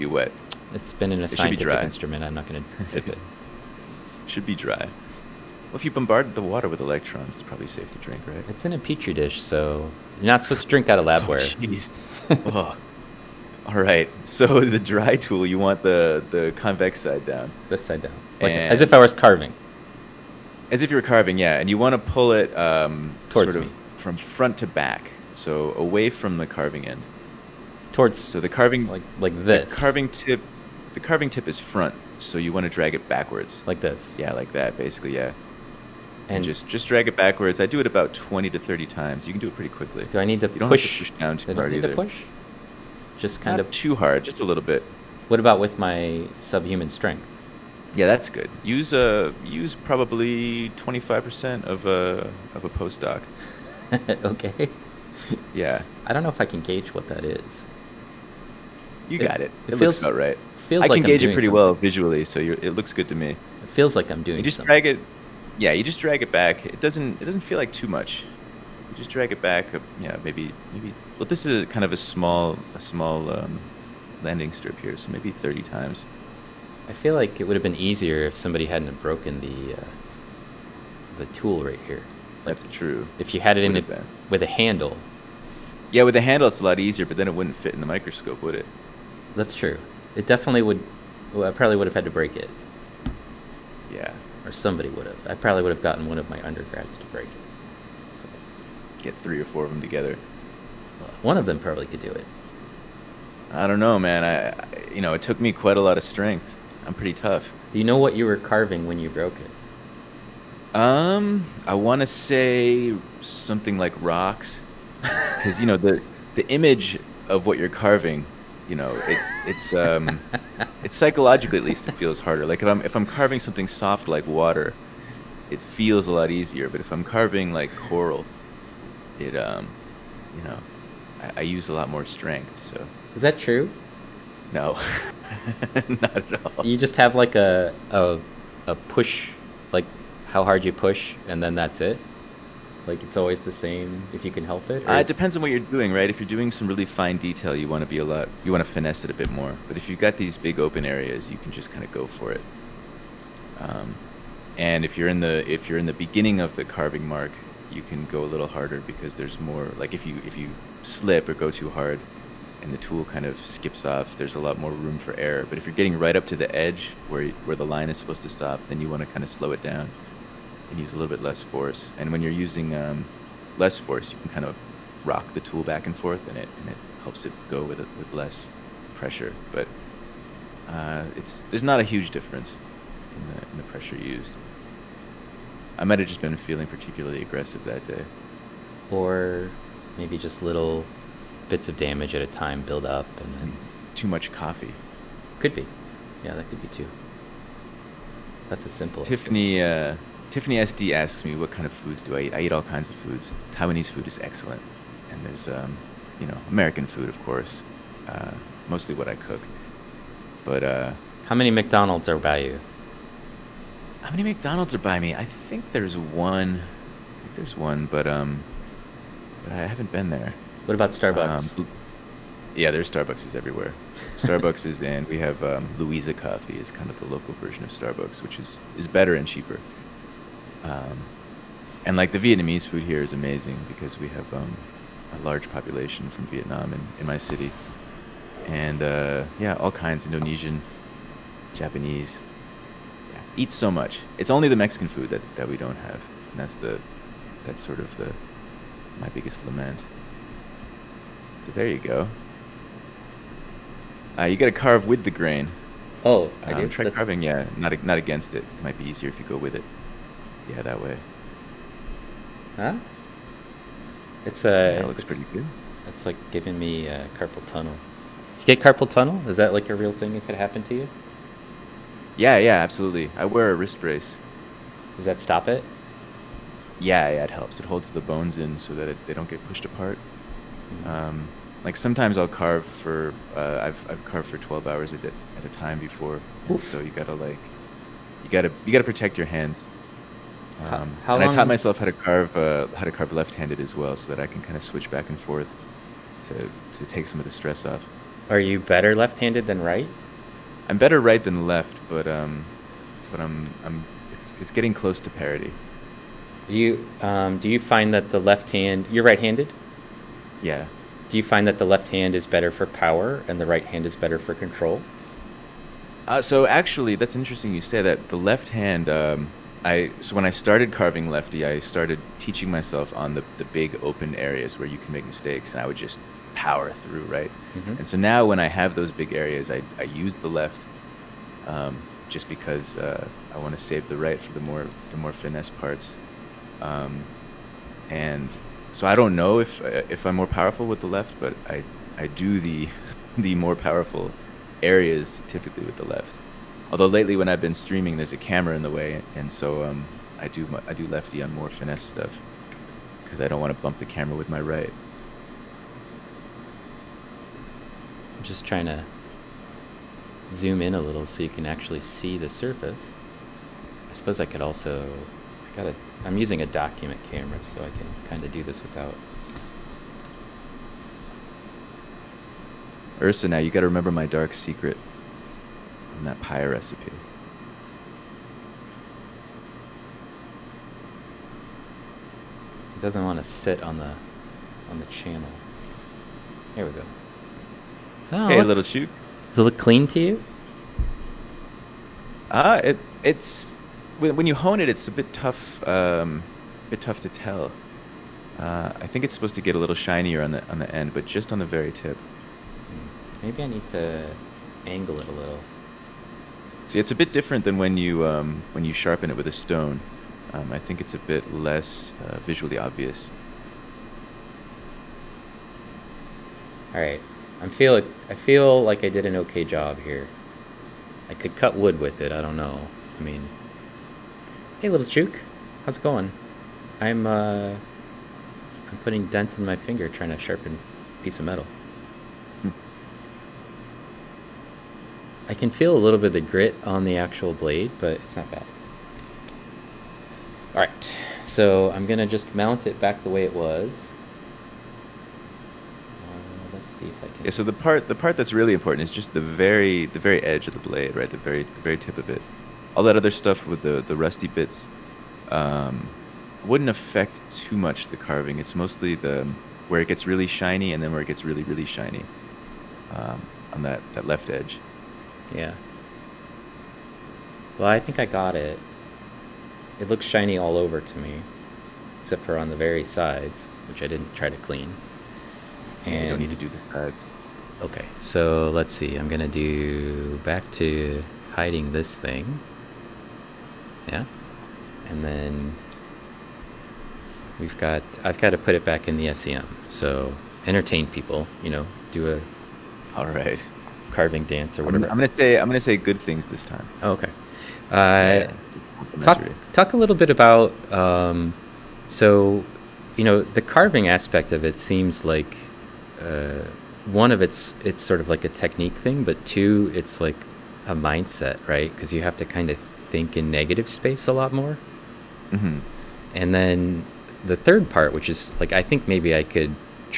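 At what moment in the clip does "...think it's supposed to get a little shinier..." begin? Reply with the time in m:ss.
6:38.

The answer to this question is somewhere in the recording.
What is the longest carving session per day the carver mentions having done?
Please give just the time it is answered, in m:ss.
4:44.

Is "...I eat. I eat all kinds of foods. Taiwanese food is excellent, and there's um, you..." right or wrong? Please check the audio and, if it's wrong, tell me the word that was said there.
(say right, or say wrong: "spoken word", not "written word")
right.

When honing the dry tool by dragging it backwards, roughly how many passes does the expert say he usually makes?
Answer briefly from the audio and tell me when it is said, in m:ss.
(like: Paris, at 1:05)
20 to 30, at 0:38.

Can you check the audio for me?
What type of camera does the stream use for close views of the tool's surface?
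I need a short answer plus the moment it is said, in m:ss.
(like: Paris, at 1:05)
document camera, at 6:06.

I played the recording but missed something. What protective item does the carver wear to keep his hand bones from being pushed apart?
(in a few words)
wrist brace.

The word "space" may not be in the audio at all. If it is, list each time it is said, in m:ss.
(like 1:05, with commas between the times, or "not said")
8:33.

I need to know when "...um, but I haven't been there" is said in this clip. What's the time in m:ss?
3:38.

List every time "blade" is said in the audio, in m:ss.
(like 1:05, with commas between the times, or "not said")
7:17, 7:30.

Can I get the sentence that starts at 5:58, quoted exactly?
I'm just trying to zoom in a little so you can actually see the surface.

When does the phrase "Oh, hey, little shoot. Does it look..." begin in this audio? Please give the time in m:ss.
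6:28.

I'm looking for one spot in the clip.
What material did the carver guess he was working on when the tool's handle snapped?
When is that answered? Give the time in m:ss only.
1:54.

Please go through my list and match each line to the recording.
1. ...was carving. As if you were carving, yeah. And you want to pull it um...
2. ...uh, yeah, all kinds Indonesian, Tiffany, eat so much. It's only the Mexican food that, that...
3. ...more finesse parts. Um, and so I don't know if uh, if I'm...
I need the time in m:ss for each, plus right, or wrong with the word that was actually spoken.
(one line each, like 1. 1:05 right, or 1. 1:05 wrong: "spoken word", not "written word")
1. 0:18 right
2. 3:58 wrong: "Japanese", not "Tiffany"
3. 5:34 right.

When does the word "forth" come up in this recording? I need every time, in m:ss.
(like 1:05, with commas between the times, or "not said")
2:55, 4:55.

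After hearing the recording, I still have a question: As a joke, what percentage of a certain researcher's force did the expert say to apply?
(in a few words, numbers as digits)
25%.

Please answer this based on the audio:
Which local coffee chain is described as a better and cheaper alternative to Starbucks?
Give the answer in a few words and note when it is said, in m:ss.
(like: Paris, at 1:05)
Louisa Coffee, at 3:45.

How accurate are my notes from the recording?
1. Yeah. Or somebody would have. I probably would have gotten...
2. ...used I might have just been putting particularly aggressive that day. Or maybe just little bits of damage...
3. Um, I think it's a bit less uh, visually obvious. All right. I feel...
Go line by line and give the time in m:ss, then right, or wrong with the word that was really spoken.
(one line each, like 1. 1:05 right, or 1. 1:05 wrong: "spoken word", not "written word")
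1. 1:33 right
2. 3:03 wrong: "feeling", not "putting"
3. 6:50 right.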